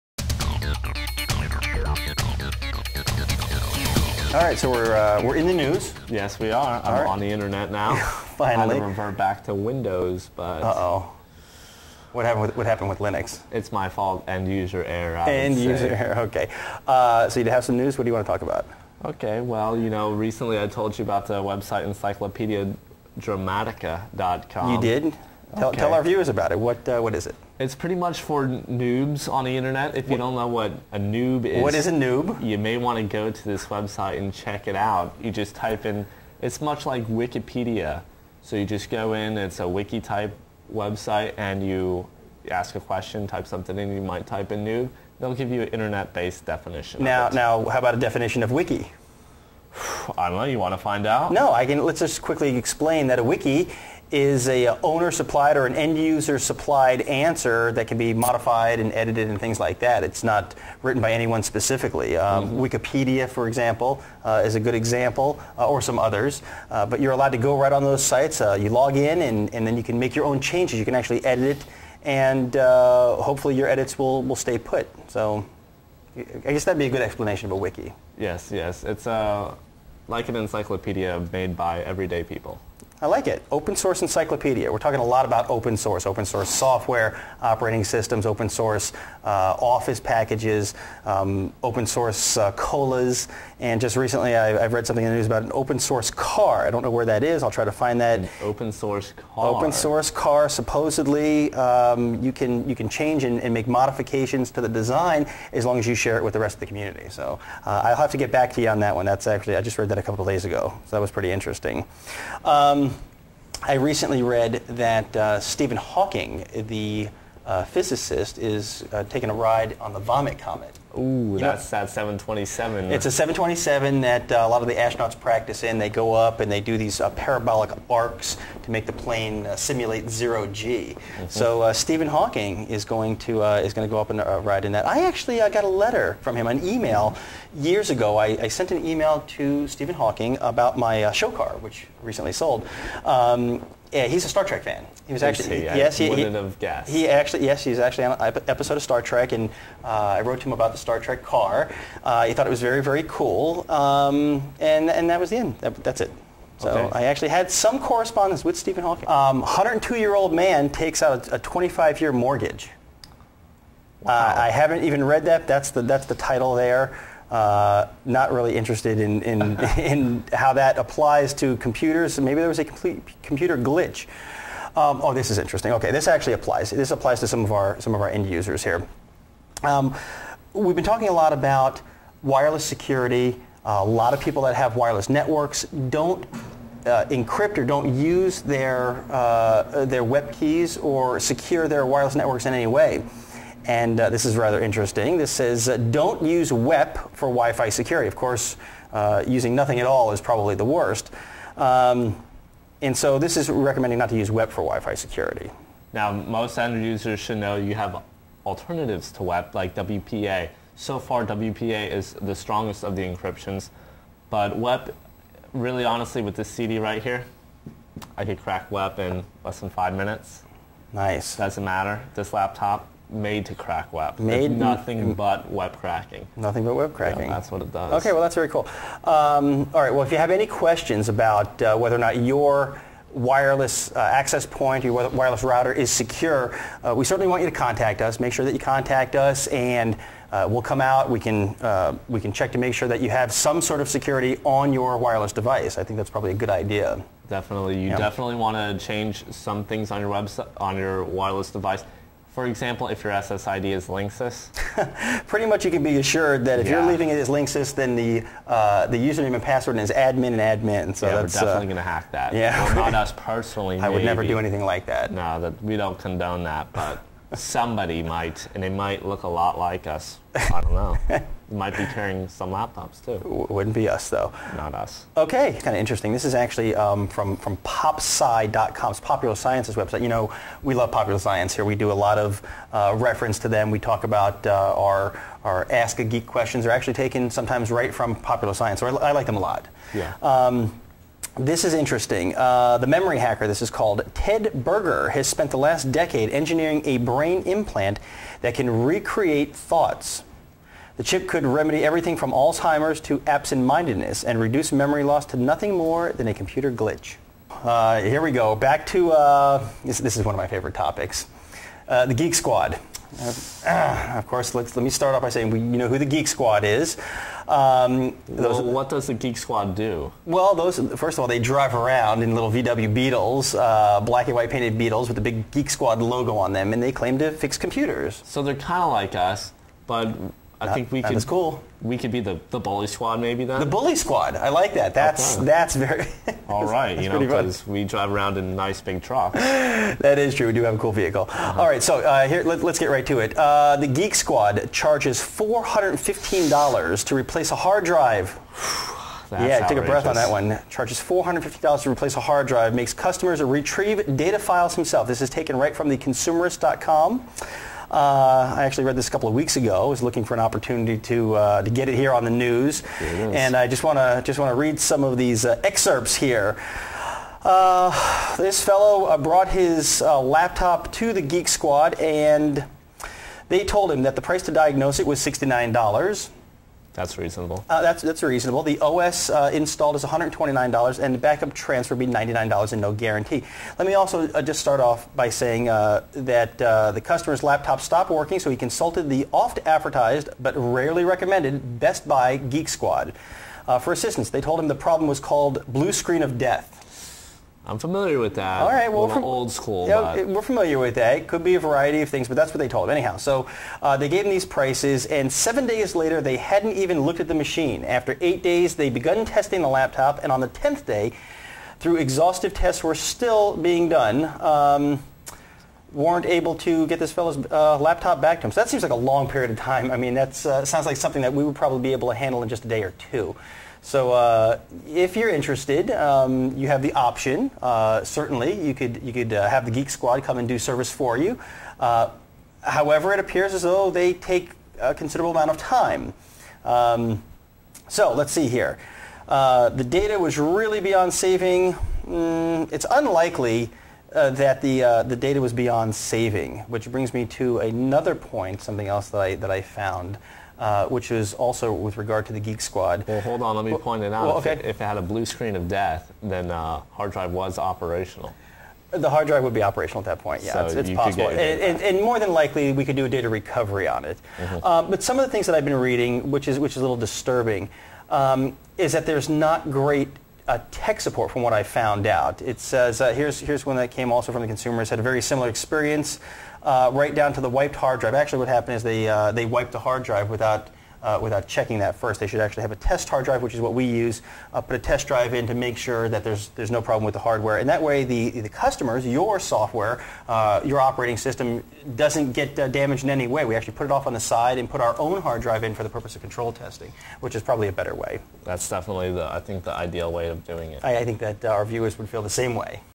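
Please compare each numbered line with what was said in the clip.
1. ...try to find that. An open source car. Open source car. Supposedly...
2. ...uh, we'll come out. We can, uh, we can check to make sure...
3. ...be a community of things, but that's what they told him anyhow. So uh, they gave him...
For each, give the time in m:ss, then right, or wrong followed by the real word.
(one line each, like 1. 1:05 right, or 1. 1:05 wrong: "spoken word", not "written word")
1. 1:37 right
2. 4:00 right
3. 6:41 wrong: "variety", not "community".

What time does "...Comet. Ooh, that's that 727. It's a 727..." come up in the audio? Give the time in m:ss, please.
2:00.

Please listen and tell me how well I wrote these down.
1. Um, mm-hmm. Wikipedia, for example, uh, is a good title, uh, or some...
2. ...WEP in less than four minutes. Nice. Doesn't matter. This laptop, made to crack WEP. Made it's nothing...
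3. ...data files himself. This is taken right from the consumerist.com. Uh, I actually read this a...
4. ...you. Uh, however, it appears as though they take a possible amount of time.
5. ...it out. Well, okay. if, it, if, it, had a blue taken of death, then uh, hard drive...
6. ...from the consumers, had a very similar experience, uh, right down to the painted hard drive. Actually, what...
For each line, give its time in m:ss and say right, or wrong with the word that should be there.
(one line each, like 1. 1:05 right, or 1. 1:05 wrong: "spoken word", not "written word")
1. 1:02 wrong: "example", not "title"
2. 3:38 wrong: "five", not "four"
3. 5:54 right
4. 7:11 wrong: "considerable", not "possible"
5. 7:34 wrong: "screen", not "taken"
6. 7:54 wrong: "wiped", not "painted".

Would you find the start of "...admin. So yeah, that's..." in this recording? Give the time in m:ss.
4:20.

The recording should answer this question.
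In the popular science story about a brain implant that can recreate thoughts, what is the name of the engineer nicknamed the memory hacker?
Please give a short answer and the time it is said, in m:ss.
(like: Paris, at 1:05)
Ted Berger, at 4:54.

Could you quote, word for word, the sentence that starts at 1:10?
You can actually edit it, and uh, hopefully your edits will, will stay put.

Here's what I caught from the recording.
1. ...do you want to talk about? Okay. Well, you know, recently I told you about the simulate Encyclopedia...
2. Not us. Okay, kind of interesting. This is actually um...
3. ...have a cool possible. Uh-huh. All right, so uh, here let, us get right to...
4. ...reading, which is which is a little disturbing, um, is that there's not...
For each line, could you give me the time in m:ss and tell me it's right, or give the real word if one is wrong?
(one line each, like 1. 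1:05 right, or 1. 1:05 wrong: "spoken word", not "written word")
1. 0:18 wrong: "website", not "simulate"
2. 4:34 right
3. 5:40 wrong: "vehicle", not "possible"
4. 7:45 right.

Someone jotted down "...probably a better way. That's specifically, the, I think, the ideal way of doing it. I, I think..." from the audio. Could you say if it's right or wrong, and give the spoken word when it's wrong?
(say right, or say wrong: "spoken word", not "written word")
wrong: "definitely", not "specifically".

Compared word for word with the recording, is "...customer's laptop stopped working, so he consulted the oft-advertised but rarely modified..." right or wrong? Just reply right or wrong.
wrong.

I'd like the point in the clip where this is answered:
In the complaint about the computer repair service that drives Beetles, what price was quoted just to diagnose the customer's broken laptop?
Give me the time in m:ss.
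6:15.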